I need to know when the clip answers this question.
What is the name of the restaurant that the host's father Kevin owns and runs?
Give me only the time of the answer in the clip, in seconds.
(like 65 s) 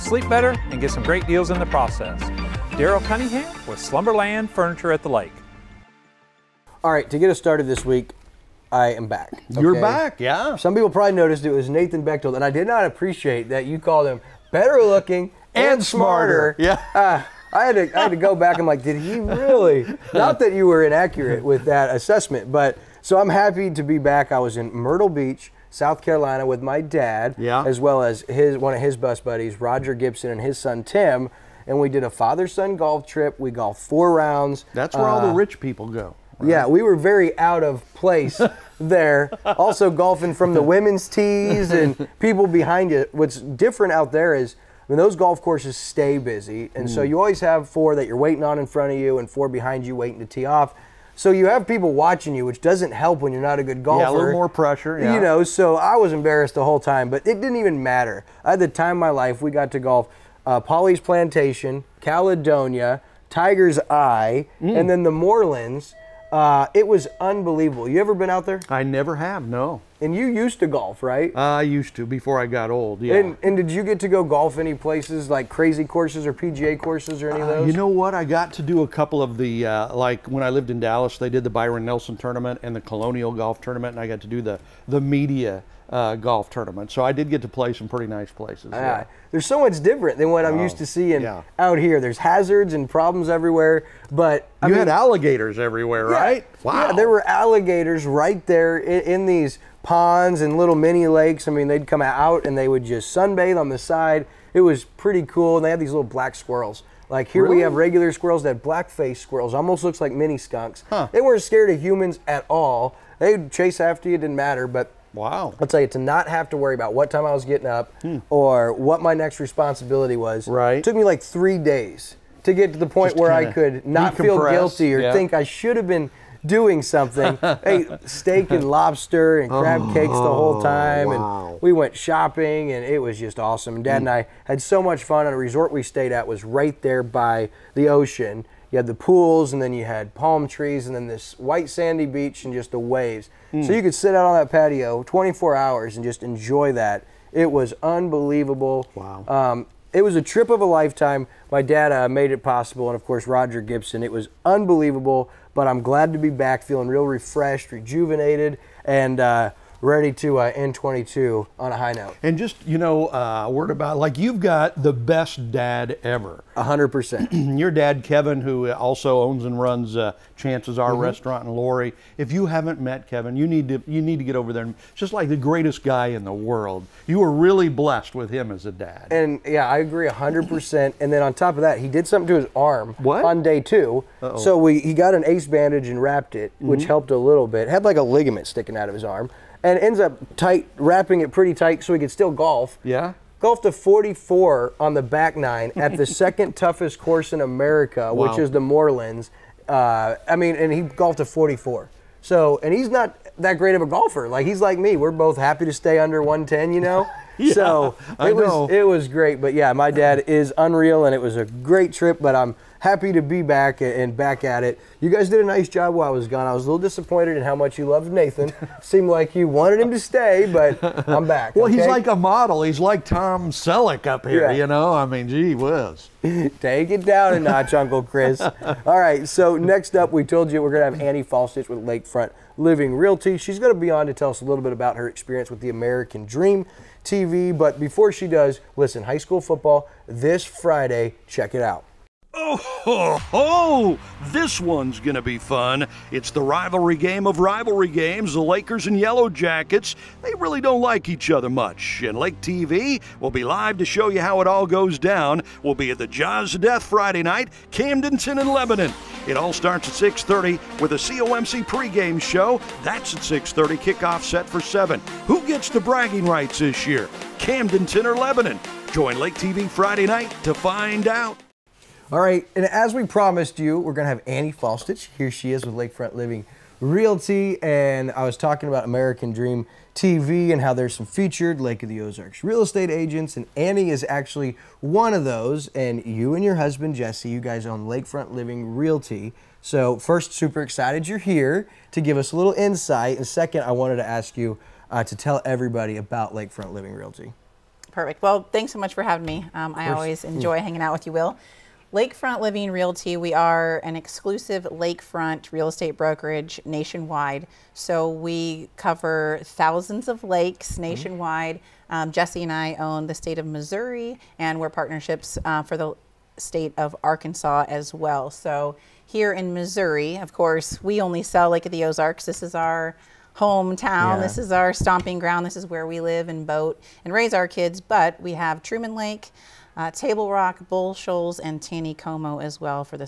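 170 s.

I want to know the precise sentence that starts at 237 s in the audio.
But before she does, listen, high school football this Friday.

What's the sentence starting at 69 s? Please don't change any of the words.
And you used to golf, right?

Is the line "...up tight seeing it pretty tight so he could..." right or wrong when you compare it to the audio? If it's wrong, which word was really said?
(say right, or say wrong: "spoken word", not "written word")
wrong: "wrapping", not "seeing".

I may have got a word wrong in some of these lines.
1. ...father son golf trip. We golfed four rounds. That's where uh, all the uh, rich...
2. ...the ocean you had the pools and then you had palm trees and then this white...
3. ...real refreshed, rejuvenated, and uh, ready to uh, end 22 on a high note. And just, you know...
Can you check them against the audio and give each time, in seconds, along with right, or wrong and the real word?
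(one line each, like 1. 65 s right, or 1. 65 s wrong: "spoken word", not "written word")
1. 32 s right
2. 137 s right
3. 156 s right.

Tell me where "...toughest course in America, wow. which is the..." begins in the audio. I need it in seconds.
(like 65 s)
196 s.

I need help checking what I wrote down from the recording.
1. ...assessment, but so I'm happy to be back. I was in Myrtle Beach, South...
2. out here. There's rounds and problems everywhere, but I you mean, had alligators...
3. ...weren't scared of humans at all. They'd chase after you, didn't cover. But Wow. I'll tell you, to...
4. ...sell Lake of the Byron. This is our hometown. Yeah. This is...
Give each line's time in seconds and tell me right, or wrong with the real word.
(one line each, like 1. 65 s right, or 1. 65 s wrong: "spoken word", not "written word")
1. 21 s right
2. 91 s wrong: "hazards", not "rounds"
3. 111 s wrong: "matter", not "cover"
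4. 321 s wrong: "Ozarks", not "Byron".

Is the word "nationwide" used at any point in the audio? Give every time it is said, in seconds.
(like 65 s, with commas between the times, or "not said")
306 s, 310 s.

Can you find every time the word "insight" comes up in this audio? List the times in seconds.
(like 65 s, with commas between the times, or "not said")
292 s.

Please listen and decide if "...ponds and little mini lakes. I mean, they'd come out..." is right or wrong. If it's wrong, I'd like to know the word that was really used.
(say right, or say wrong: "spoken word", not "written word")
right.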